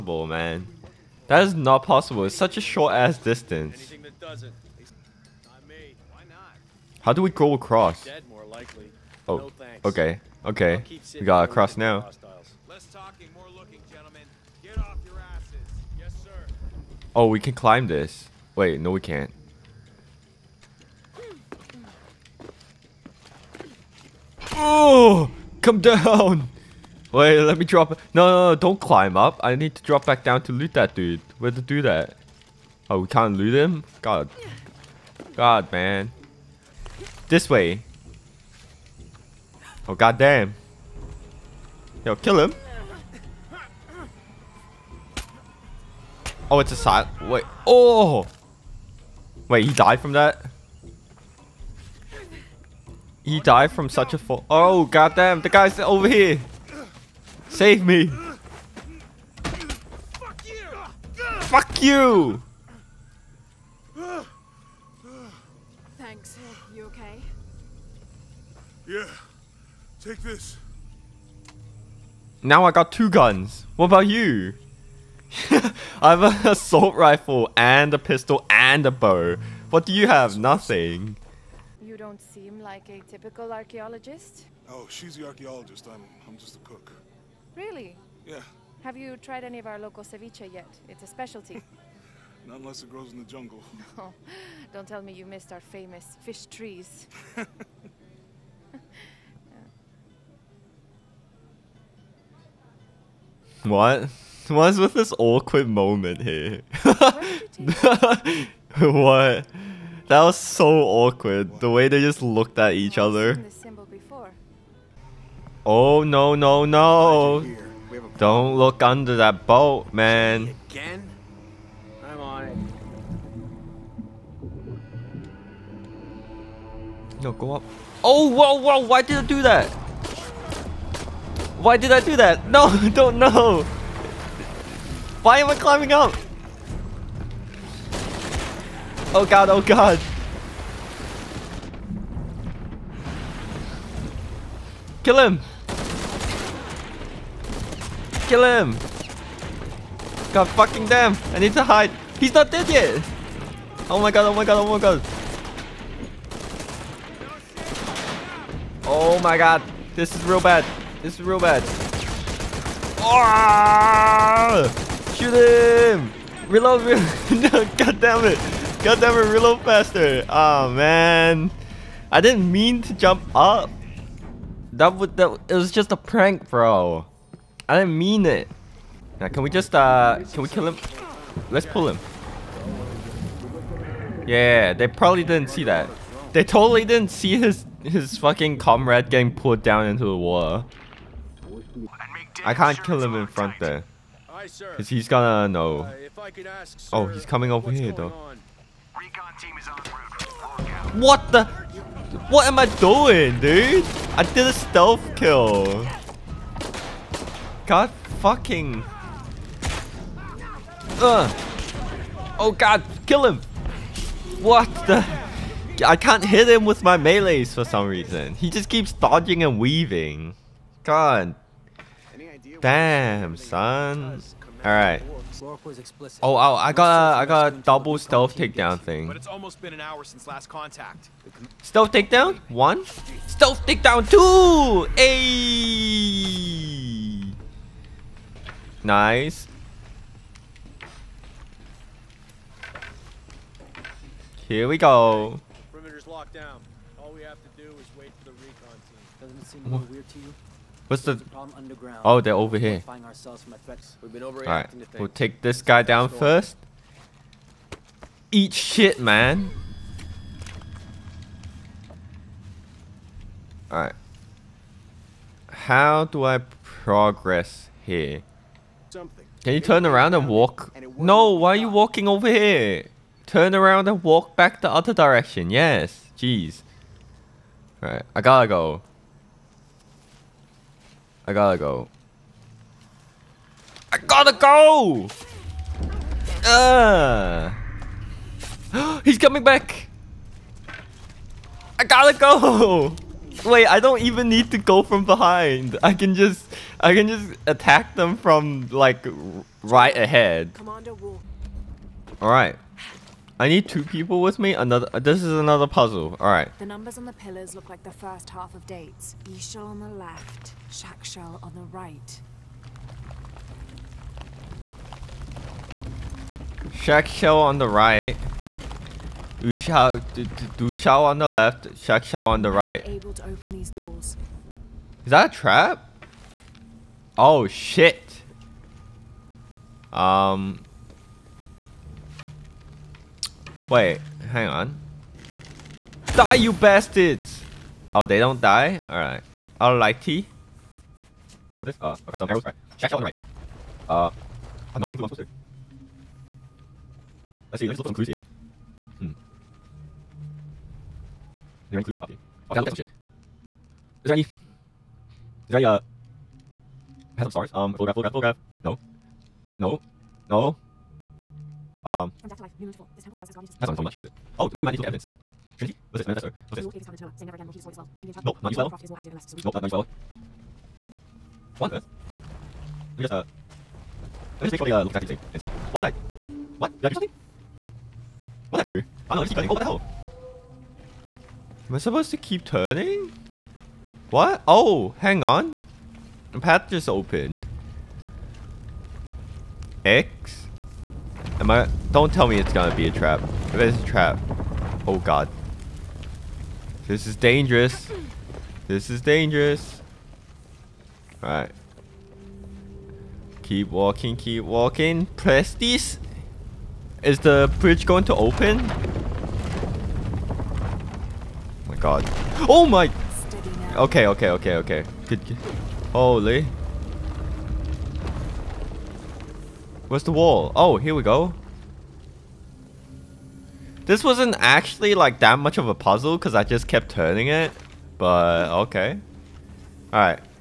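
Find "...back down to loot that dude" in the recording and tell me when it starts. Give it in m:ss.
0:30.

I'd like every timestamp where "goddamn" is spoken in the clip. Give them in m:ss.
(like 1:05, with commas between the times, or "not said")
0:39, 0:54.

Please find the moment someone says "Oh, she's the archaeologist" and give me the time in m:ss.
1:24.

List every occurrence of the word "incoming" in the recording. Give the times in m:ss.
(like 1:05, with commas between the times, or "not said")
not said.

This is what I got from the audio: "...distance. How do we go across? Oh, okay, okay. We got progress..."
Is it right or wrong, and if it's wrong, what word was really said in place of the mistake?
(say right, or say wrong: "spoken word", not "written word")
wrong: "across", not "progress".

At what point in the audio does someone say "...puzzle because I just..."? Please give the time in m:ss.
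7:05.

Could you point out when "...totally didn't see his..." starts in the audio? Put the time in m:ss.
3:06.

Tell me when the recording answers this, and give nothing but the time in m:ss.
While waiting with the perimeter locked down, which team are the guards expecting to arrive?
4:08.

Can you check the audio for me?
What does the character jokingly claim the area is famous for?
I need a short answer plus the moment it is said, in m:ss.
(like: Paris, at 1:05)
Fish trees, at 1:35.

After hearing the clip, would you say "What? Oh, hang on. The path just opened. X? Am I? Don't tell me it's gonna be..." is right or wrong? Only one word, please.
right.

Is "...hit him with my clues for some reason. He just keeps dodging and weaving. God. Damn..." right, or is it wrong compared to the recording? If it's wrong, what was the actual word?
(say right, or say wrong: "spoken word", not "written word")
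wrong: "melees", not "clues".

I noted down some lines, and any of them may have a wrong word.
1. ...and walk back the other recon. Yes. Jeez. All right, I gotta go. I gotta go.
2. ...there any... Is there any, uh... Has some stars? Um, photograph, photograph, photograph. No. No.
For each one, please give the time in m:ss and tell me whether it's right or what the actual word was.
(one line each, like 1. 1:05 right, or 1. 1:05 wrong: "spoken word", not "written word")
1. 4:33 wrong: "direction", not "recon"
2. 5:54 right.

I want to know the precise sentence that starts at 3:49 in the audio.
But it's almost been an hour since last contact.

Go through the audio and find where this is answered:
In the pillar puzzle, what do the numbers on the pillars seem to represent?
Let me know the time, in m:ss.
5:07.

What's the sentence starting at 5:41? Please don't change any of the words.
This, uh, okay, some arrows, right?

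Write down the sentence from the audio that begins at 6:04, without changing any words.
Oh, maybe we need to evidence.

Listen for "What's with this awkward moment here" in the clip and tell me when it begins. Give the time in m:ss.
1:44.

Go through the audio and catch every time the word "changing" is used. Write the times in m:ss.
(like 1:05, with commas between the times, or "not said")
not said.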